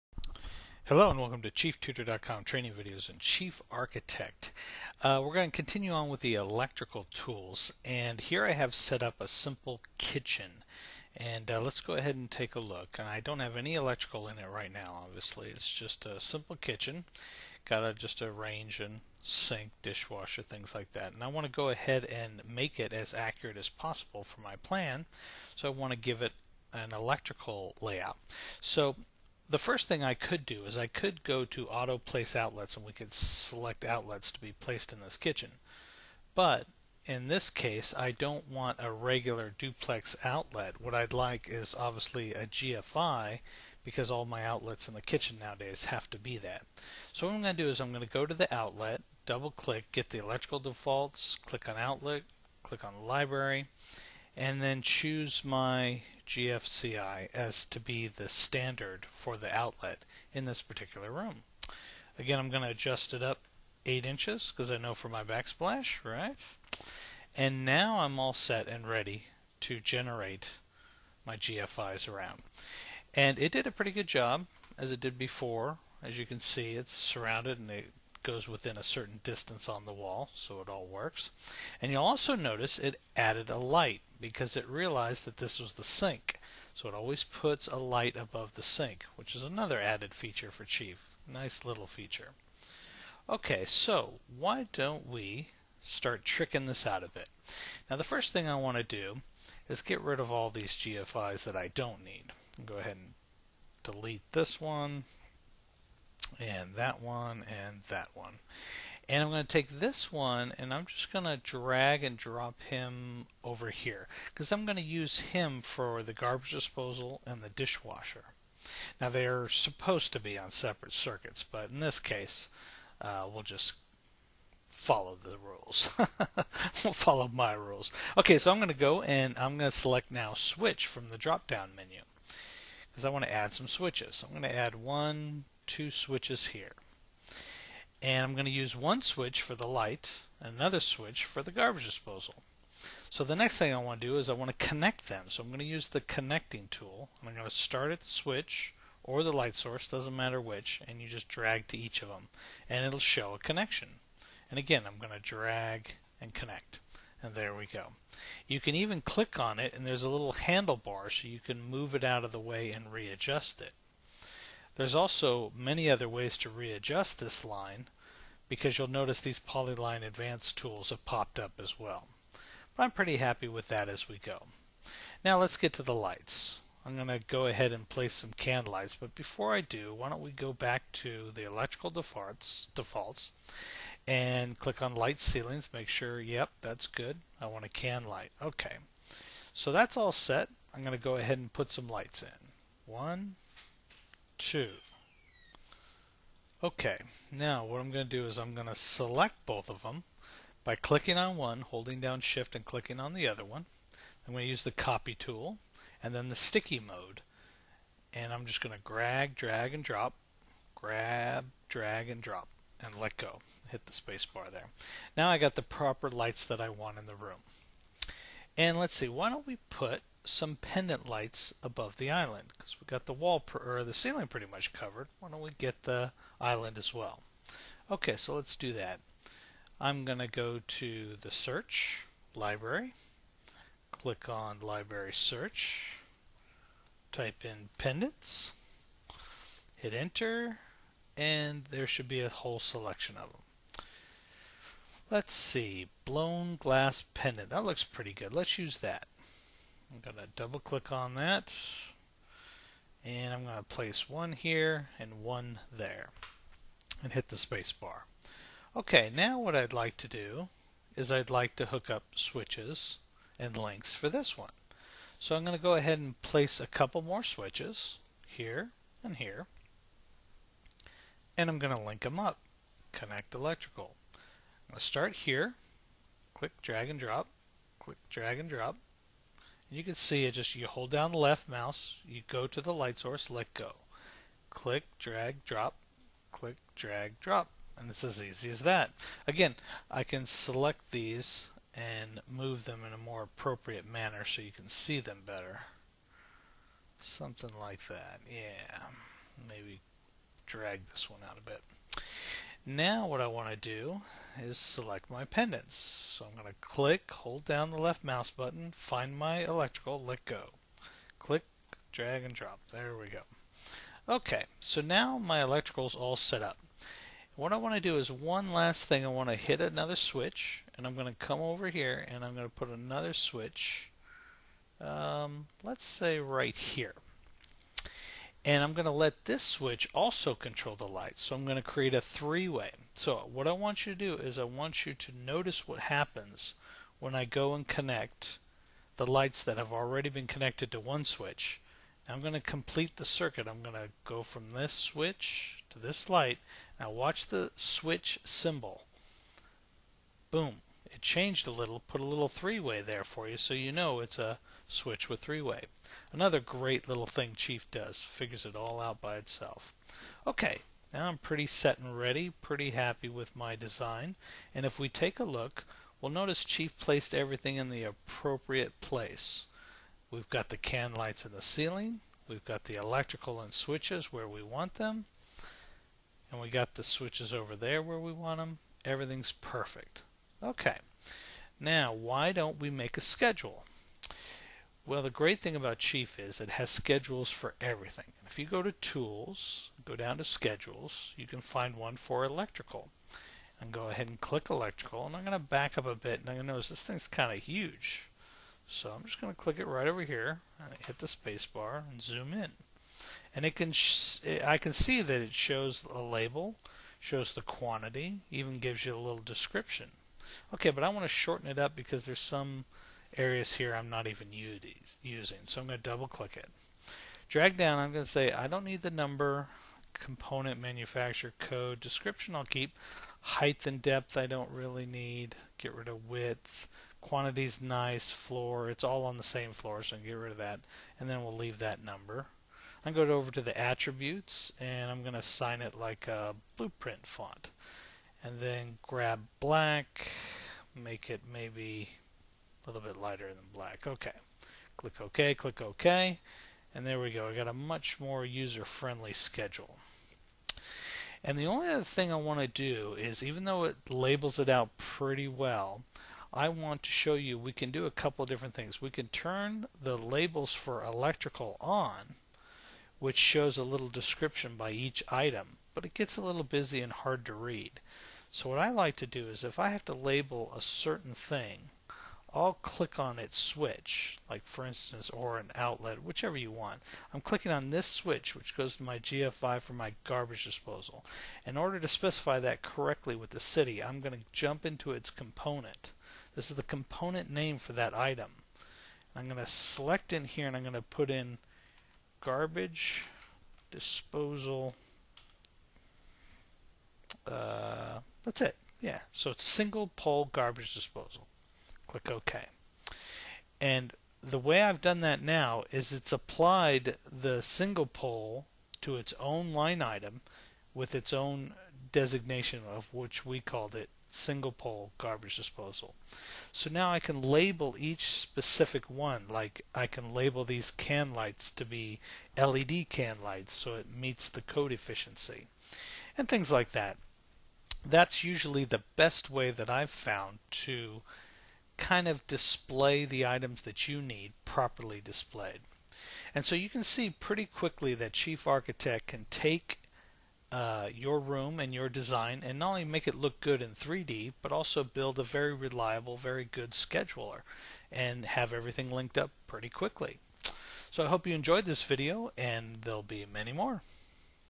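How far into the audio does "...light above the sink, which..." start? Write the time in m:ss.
1:27.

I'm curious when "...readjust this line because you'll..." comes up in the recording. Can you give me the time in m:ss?
2:46.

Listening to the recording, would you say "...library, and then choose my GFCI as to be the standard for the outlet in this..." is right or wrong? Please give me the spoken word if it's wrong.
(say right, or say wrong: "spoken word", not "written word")
right.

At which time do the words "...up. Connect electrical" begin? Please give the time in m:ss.
4:32.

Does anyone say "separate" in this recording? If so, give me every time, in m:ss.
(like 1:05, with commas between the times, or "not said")
2:00.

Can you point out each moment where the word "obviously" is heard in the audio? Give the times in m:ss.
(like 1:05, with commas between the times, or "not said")
0:15, 0:41.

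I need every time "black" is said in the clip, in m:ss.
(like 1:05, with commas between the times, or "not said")
7:19, 7:23.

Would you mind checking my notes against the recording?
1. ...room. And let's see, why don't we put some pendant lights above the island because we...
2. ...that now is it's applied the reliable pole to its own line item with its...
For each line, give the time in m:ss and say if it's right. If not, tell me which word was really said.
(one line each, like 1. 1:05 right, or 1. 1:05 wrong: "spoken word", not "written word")
1. 3:37 right
2. 8:25 wrong: "single", not "reliable".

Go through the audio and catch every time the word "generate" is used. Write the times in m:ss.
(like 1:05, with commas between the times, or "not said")
1:09.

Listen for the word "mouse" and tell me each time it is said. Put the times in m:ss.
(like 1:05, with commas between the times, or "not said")
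4:41, 5:08.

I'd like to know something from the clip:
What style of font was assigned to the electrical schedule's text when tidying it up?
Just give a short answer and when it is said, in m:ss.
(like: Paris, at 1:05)
Blueprint font, at 7:16.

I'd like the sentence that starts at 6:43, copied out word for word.
And it can, I can see that it shows a label, shows the quantity, even gives you a little description.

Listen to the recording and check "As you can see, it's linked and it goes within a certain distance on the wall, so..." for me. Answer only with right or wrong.
wrong.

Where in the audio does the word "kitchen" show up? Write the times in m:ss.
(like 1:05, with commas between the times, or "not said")
0:09, 0:16, 0:35, 0:45.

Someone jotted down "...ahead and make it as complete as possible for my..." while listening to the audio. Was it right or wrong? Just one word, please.
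wrong.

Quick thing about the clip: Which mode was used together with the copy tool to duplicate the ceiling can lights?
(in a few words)
Sticky mode.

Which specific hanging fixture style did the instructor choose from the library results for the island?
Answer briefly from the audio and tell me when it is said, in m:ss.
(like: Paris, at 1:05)
Blown glass pendant, at 4:06.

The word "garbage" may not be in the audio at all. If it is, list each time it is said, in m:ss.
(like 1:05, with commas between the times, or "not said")
1:56, 2:21, 8:00, 8:12, 8:20, 8:34.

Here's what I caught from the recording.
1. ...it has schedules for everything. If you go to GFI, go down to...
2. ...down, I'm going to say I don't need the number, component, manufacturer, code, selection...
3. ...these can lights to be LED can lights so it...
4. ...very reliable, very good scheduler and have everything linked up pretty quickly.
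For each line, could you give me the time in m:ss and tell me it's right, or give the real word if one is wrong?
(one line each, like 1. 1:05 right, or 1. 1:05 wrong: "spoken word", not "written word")
1. 6:26 wrong: "Tools", not "GFI"
2. 6:57 wrong: "description", not "selection"
3. 8:40 right
4. 9:05 right.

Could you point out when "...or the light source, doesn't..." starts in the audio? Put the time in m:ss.
2:29.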